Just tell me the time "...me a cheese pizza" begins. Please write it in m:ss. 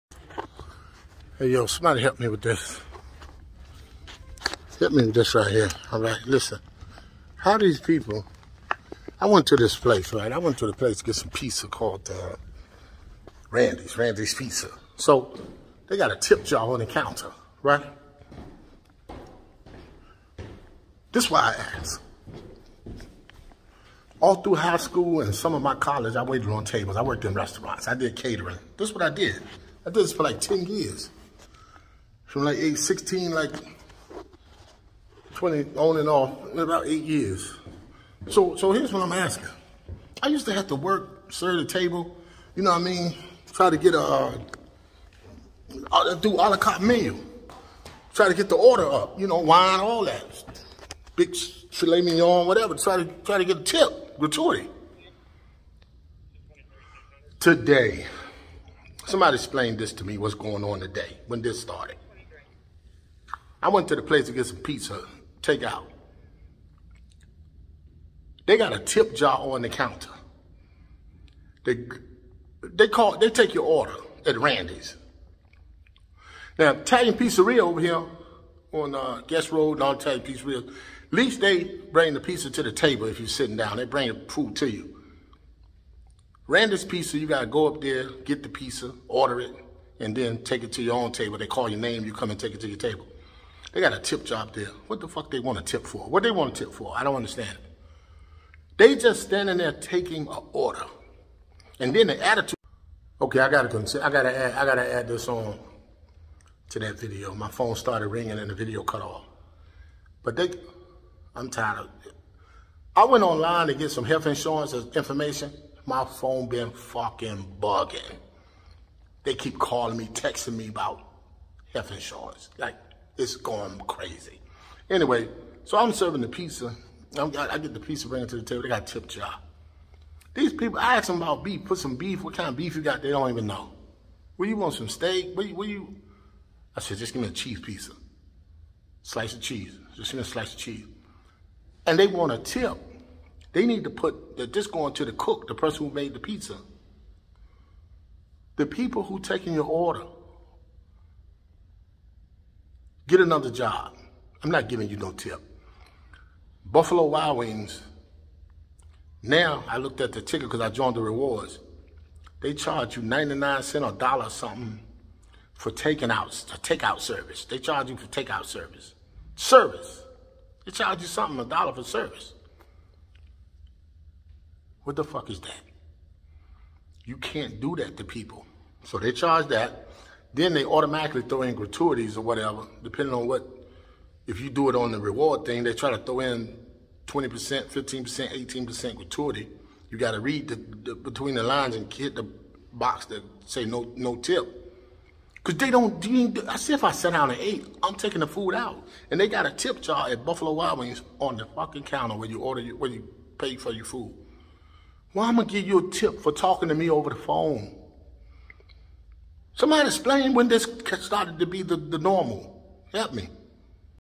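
2:17.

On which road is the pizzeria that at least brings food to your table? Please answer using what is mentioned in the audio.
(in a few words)
Guest Road.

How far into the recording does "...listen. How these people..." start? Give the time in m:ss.
0:06.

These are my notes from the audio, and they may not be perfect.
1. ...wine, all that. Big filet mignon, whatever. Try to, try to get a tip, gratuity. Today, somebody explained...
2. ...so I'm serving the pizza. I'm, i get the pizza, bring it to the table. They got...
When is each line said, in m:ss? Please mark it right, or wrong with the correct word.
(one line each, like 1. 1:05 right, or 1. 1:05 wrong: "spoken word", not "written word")
1. 0:49 right
2. 2:05 right.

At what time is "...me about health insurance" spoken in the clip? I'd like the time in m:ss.
2:00.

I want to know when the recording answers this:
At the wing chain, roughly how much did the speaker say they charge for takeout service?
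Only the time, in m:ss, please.
2:43.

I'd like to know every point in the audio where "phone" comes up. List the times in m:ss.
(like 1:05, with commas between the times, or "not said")
1:47, 1:56, 3:27.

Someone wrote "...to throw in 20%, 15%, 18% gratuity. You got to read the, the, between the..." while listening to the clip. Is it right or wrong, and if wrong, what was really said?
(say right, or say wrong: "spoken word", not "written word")
right.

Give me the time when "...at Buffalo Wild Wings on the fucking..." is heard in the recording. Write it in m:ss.
3:20.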